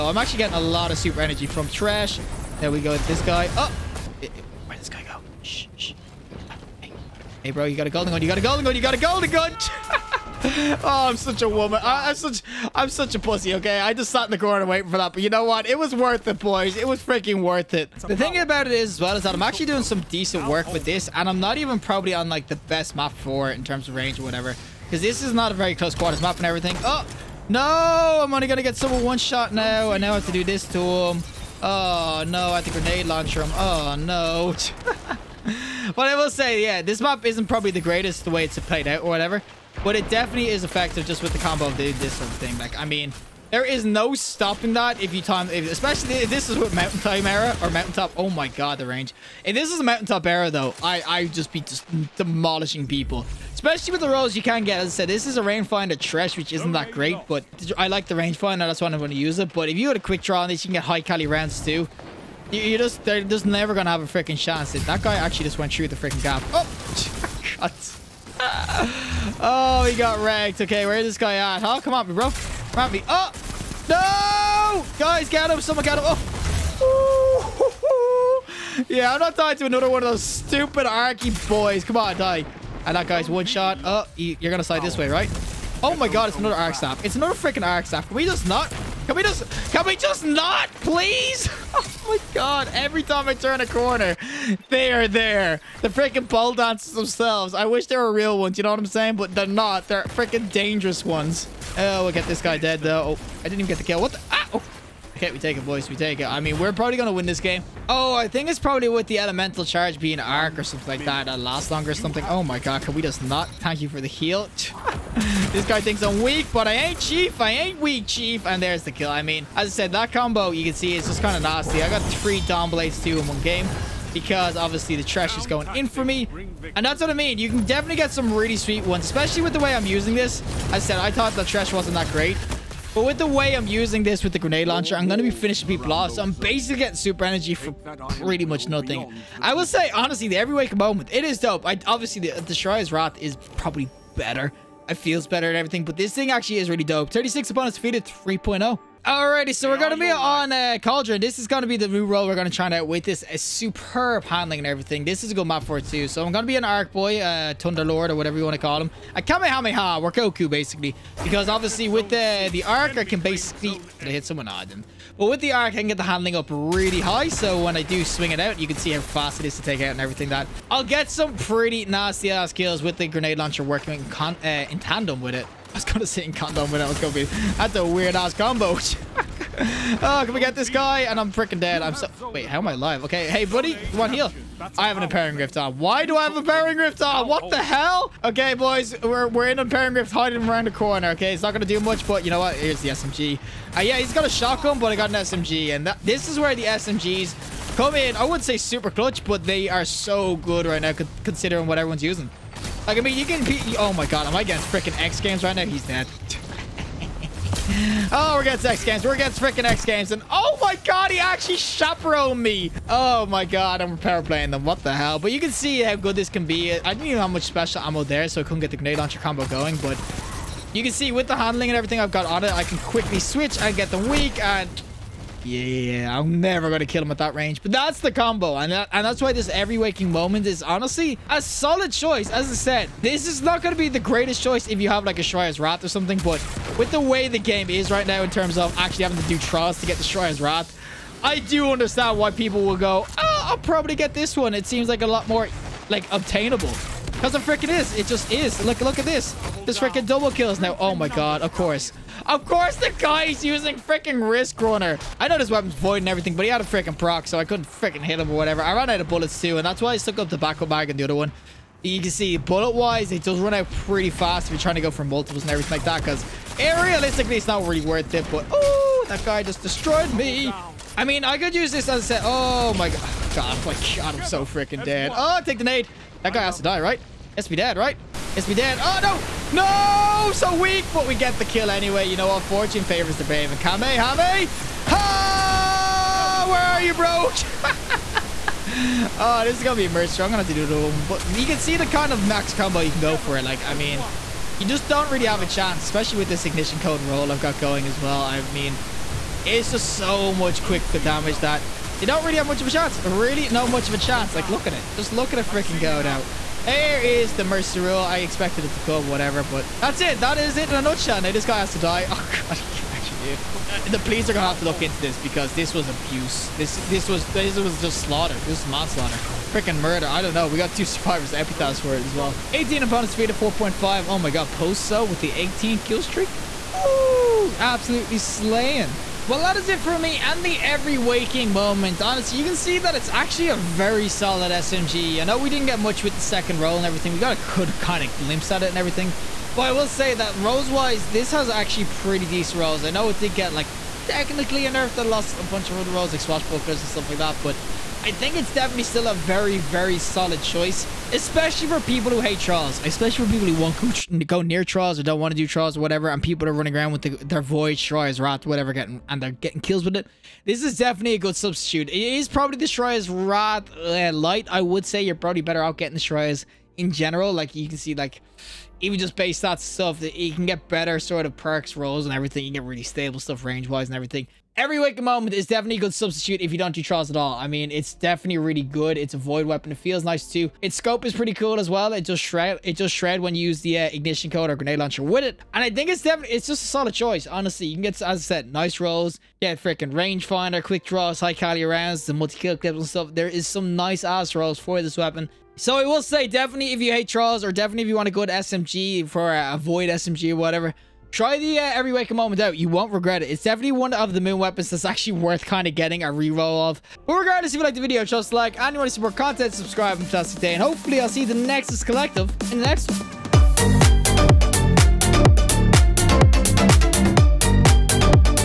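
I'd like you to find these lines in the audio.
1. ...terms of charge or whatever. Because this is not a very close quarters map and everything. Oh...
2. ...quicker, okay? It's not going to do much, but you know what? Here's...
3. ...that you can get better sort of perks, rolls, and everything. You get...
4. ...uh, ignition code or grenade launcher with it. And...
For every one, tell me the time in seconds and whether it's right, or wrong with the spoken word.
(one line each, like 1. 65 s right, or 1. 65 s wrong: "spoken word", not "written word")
1. 23 s wrong: "range", not "charge"
2. 190 s wrong: "corner", not "quicker"
3. 370 s right
4. 383 s right.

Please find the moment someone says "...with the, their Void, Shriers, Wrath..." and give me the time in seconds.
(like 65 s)
356 s.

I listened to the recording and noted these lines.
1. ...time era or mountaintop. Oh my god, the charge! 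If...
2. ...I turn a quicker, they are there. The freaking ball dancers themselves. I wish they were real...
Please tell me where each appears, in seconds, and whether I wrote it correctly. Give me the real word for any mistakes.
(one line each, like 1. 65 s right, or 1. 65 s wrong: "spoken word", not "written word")
1. 46 s wrong: "range", not "charge"
2. 93 s wrong: "corner", not "quicker".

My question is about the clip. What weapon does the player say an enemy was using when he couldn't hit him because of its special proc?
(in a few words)
Risk Runner.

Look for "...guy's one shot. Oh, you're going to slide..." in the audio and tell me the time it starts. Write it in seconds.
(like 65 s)
83 s.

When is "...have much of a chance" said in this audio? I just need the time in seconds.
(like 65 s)
302 s.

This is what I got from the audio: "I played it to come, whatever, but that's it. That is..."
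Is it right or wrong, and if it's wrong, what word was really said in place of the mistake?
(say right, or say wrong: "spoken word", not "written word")
wrong: "expected", not "played".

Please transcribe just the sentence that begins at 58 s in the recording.
That's why I'm going to use it.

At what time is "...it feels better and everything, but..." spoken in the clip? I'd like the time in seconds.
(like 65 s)
144 s.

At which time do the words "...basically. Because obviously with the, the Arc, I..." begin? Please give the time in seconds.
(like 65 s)
160 s.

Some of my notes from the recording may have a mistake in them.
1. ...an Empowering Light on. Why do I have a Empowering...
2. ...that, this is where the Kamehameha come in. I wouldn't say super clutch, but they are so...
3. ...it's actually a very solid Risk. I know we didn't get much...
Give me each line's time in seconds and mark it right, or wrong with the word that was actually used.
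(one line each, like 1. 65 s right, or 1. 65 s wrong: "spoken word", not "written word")
1. 184 s wrong: "Rift", not "Light"
2. 195 s wrong: "SMGs", not "Kamehameha"
3. 332 s wrong: "SMG", not "Risk".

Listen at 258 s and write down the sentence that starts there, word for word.
I ran out of bullets too, and that's why I stuck up the backup bag and the other one.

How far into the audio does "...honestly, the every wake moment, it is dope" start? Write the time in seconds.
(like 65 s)
139 s.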